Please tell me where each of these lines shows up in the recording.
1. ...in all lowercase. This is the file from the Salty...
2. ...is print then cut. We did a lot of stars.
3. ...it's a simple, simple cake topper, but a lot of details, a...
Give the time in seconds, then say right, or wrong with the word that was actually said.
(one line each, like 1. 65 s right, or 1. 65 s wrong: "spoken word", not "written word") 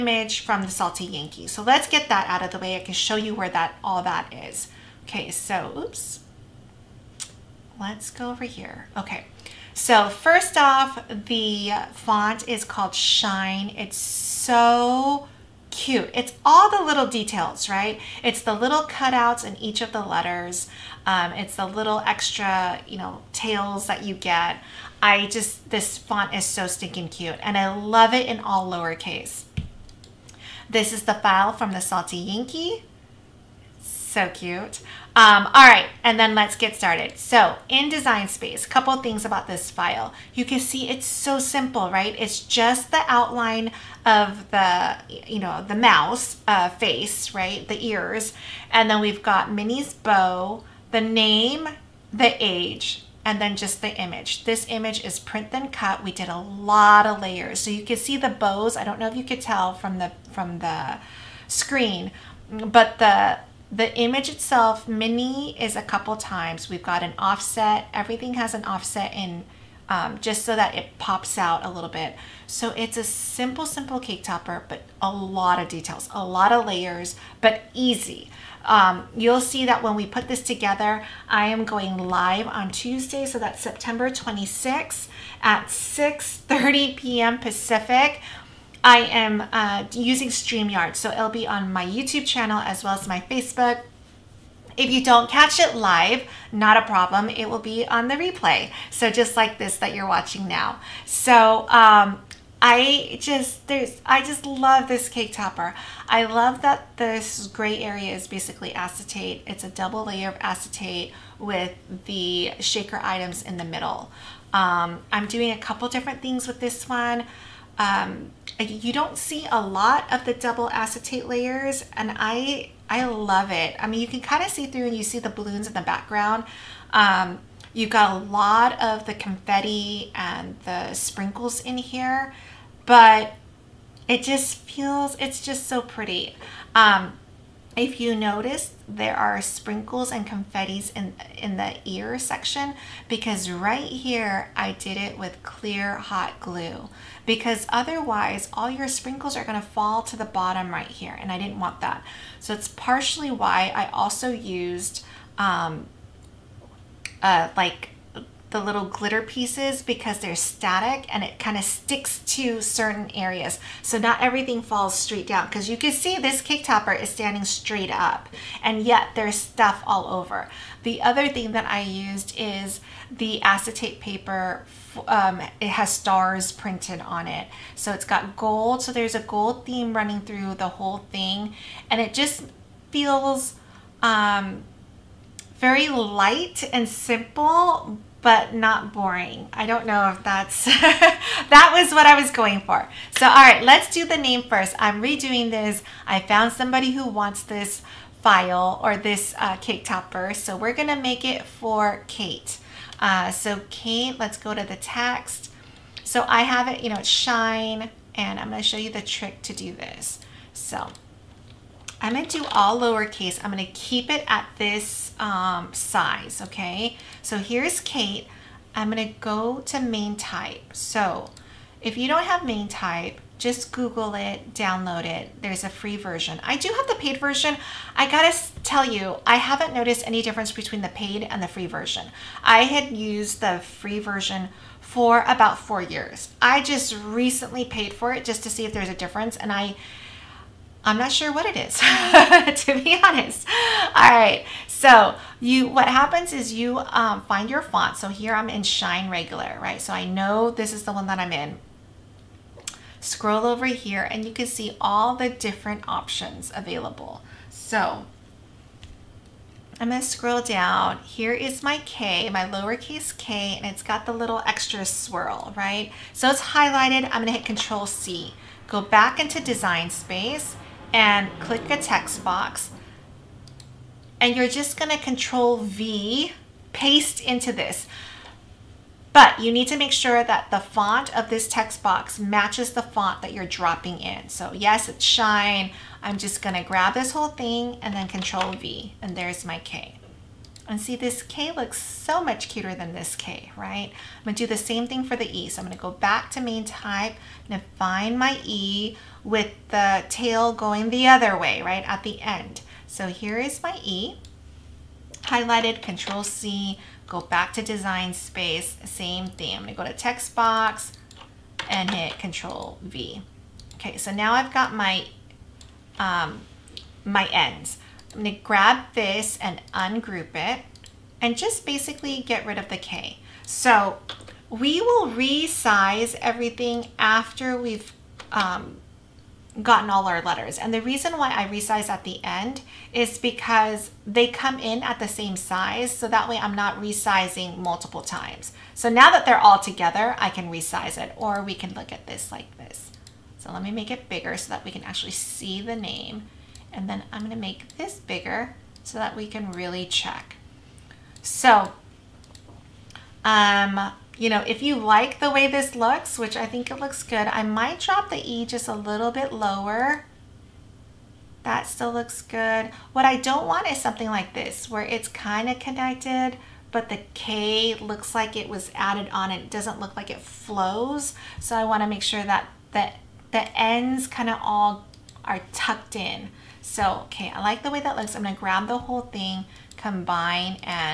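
1. 28 s right
2. 55 s wrong: "layers", not "stars"
3. 72 s right.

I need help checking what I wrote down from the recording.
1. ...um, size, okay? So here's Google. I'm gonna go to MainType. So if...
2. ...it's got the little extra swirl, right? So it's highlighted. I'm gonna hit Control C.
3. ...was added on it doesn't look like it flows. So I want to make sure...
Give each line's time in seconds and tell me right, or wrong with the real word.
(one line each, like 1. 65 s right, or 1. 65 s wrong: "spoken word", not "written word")
1. 215 s wrong: "Kate", not "Google"
2. 263 s right
3. 368 s right.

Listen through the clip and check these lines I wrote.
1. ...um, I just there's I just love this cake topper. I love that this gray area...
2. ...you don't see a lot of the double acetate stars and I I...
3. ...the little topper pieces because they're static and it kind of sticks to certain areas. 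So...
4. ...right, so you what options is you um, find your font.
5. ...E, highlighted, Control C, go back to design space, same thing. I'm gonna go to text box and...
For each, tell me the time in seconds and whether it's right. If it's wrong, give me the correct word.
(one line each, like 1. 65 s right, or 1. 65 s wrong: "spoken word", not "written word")
1. 101 s right
2. 118 s wrong: "layers", not "stars"
3. 158 s wrong: "glitter", not "topper"
4. 244 s wrong: "happens", not "options"
5. 303 s right.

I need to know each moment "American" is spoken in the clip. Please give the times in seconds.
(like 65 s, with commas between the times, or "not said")
not said.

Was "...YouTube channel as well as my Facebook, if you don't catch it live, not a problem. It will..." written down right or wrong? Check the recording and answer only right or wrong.
right.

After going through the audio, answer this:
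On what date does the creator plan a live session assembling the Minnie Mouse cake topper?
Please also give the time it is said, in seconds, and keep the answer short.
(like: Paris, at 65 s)
September 26th, at 83 s.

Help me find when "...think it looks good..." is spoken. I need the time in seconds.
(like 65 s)
356 s.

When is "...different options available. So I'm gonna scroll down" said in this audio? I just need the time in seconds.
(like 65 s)
255 s.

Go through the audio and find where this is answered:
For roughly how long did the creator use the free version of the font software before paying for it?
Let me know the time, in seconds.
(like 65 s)
235 s.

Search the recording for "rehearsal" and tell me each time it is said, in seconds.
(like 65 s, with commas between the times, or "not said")
not said.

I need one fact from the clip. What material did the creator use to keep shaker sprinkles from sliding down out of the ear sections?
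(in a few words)
Clear hot glue.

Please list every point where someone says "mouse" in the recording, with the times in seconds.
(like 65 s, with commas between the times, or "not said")
45 s.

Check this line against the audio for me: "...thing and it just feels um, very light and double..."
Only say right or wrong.
wrong.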